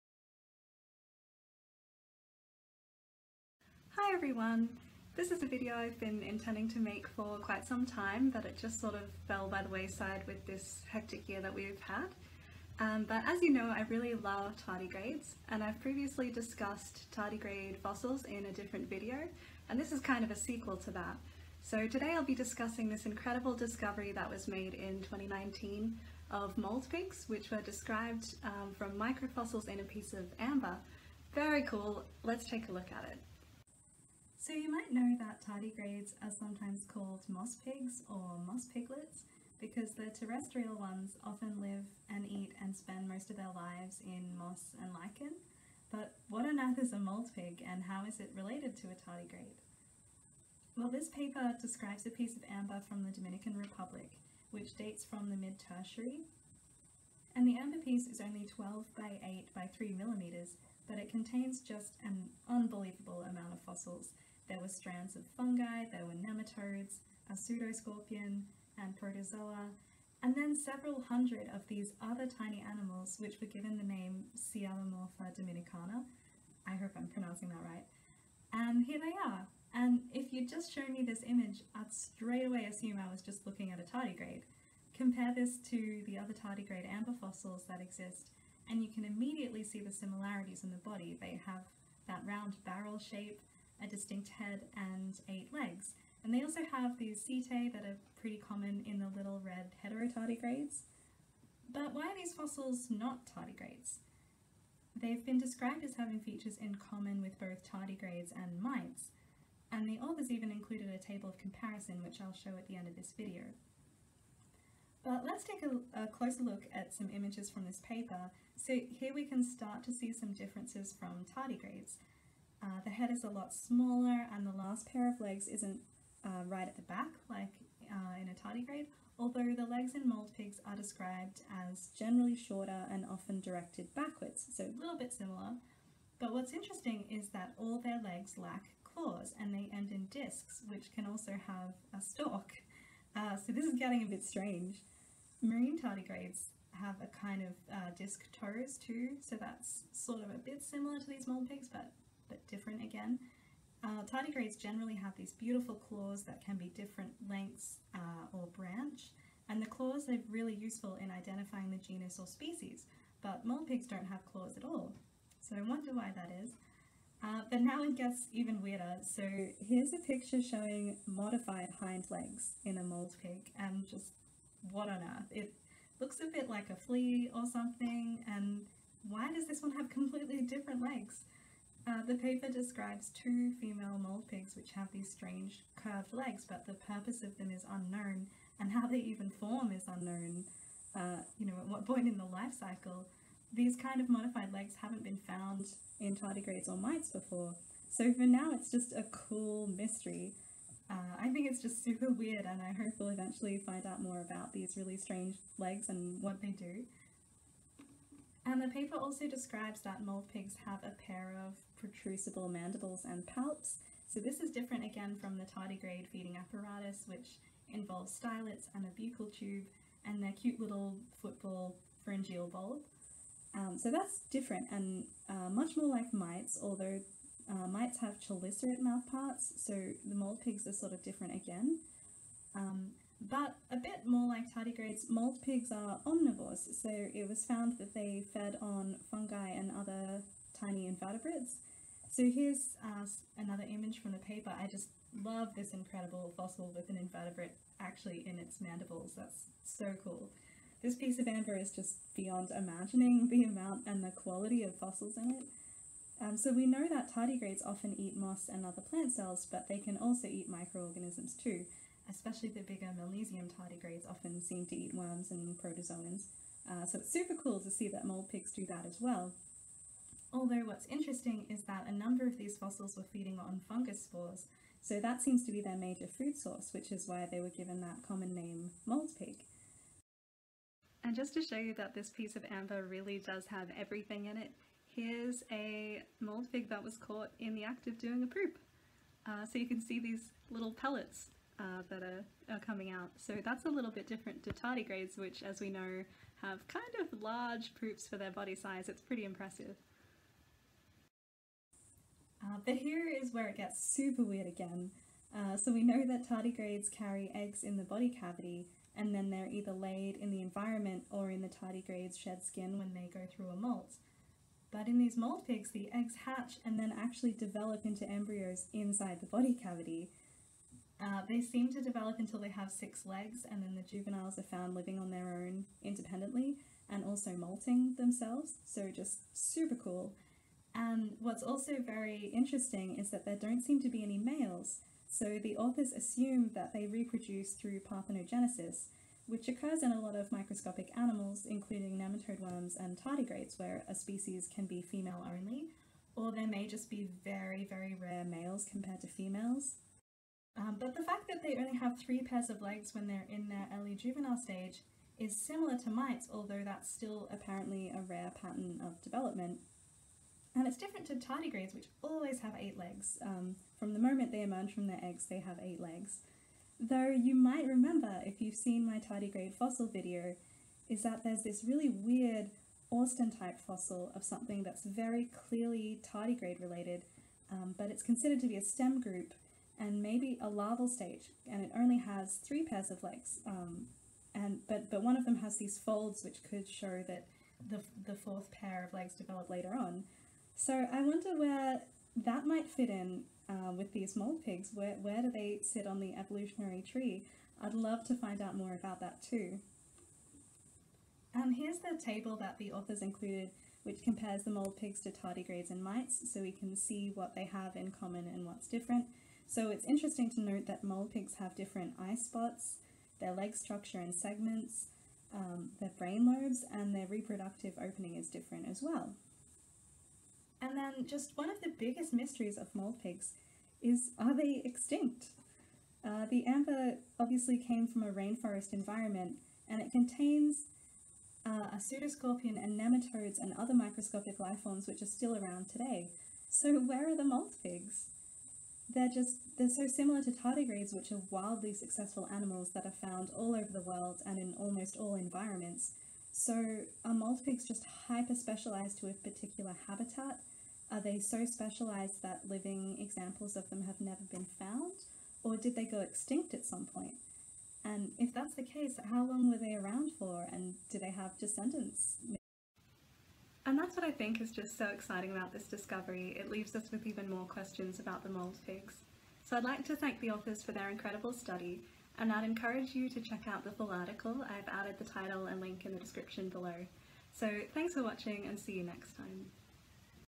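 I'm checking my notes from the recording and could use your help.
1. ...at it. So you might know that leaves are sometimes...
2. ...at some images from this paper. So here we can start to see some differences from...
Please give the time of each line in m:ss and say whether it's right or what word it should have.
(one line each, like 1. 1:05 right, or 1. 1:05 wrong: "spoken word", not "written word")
1. 0:32 wrong: "tardigrades", not "leaves"
2. 1:56 right.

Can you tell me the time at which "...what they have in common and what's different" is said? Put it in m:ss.
6:47.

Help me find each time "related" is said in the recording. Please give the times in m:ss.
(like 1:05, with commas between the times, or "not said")
0:48, 6:16.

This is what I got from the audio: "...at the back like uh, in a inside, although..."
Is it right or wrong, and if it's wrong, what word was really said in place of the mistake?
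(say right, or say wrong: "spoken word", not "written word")
wrong: "tardigrade", not "inside".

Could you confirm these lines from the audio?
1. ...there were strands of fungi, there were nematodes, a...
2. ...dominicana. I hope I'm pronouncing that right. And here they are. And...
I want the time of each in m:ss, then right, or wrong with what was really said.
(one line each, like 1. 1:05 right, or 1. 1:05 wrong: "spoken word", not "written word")
1. 1:04 right
2. 1:15 right.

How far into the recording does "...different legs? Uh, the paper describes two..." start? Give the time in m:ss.
3:00.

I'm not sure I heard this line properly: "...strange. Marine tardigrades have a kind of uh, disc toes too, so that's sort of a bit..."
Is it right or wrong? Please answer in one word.
right.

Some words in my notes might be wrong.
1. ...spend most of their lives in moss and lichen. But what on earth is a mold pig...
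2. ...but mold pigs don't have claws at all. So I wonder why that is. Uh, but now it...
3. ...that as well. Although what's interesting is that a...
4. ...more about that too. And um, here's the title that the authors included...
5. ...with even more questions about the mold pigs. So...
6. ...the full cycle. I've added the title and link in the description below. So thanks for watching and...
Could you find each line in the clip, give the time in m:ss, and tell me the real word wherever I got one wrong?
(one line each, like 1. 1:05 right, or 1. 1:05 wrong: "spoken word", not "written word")
1. 0:42 right
2. 2:43 right
3. 4:28 right
4. 6:38 wrong: "table", not "title"
5. 7:46 right
6. 7:53 wrong: "article", not "cycle".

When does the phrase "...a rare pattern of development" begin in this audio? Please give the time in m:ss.
5:57.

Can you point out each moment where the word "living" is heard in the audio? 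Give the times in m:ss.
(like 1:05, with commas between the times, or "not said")
5:24, 7:32.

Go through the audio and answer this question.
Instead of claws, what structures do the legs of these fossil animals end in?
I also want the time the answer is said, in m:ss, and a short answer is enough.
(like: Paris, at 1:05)
discs, at 2:20.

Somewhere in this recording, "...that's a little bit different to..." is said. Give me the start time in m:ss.
4:53.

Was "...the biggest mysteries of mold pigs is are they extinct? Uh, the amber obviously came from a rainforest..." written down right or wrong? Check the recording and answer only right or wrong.
right.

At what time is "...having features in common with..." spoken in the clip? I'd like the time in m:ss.
1:45.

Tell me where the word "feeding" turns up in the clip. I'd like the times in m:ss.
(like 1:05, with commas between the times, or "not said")
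3:36, 4:33.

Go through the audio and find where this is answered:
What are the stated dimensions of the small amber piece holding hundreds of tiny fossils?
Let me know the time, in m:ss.
0:58.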